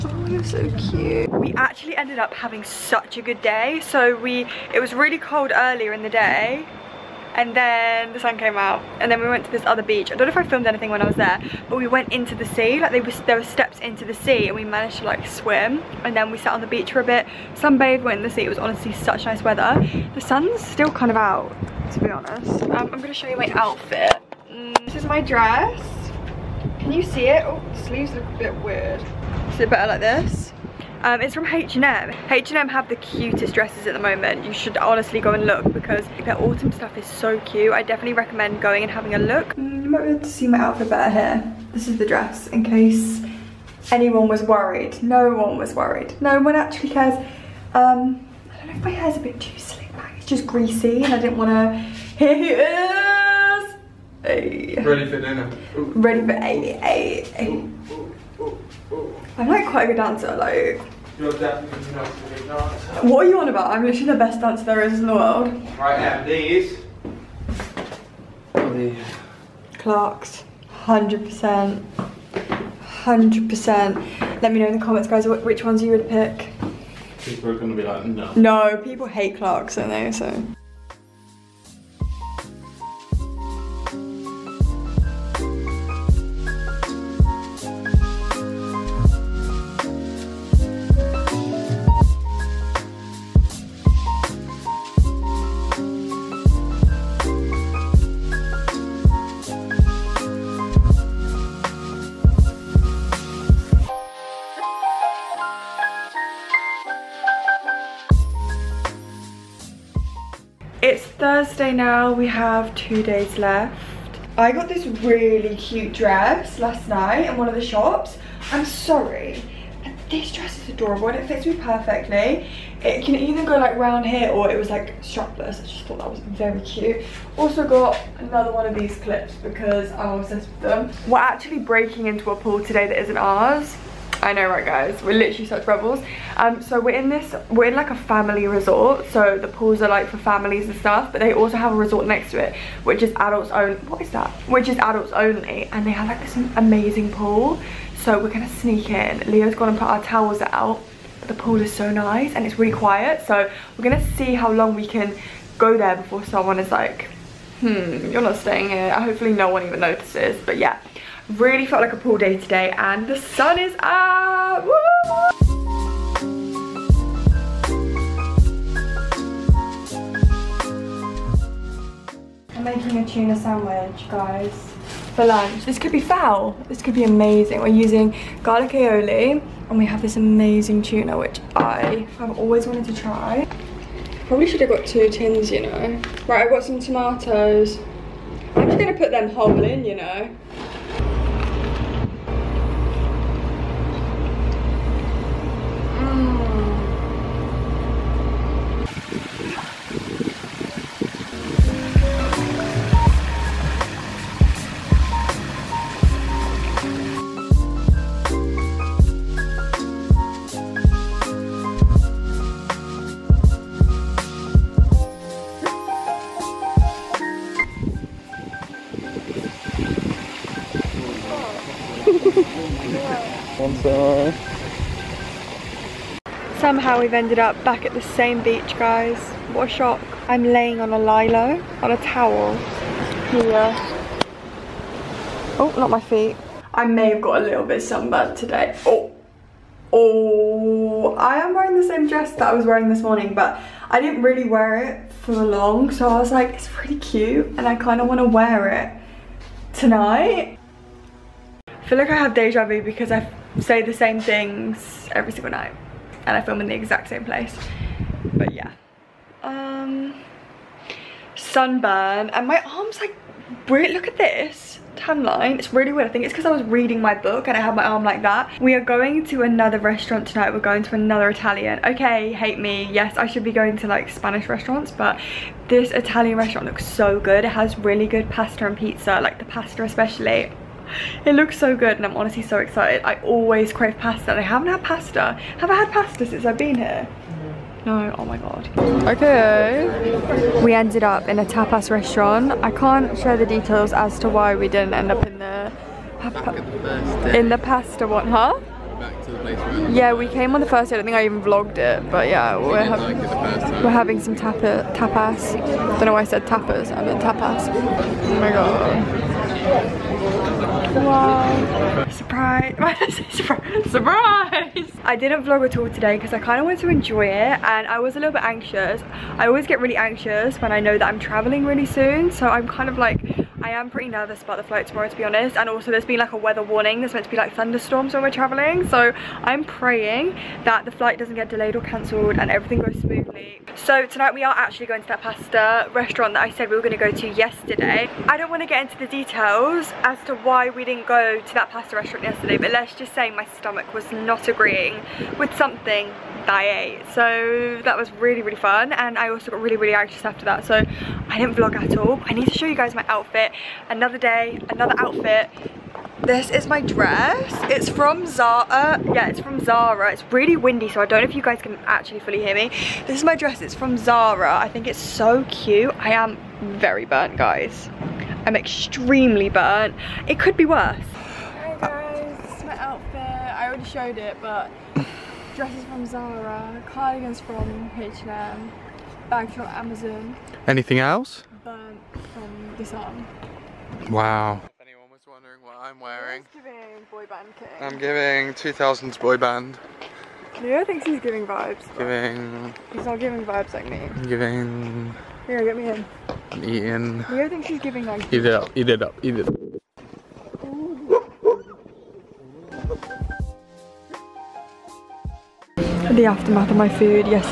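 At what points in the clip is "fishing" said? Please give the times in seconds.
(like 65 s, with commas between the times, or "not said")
not said.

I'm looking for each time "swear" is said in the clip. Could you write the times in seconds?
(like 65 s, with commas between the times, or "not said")
not said.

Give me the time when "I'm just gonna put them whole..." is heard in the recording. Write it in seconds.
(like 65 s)
188 s.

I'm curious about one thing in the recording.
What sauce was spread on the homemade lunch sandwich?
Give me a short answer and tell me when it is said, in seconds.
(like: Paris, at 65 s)
Garlic aioli, at 178 s.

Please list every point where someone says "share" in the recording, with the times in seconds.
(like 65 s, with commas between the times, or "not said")
293 s.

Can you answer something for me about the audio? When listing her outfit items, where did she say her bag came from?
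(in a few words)
Amazon.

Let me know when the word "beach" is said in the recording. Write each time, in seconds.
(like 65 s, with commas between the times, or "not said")
9 s, 16 s, 228 s.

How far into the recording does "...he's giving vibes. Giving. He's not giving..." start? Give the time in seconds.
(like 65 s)
391 s.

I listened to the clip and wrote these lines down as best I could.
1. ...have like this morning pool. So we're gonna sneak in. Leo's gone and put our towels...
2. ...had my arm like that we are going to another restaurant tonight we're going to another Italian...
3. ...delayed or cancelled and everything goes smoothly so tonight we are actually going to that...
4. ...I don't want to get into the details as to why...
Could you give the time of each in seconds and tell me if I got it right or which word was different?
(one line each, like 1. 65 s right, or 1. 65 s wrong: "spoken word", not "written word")
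1. 145 s wrong: "amazing", not "morning"
2. 267 s right
3. 331 s right
4. 338 s right.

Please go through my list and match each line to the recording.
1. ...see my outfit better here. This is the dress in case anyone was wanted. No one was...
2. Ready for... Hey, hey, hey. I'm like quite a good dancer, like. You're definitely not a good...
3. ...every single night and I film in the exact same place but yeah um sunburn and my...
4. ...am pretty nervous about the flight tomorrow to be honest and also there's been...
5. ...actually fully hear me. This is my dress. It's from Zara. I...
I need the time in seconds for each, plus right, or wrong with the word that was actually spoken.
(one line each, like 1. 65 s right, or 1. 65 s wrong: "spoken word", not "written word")
1. 40 s wrong: "worried", not "wanted"
2. 55 s right
3. 255 s right
4. 323 s right
5. 361 s right.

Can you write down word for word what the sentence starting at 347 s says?
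So that was really, really fun.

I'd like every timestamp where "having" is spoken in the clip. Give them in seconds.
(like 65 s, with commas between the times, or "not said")
2 s, 38 s, 303 s.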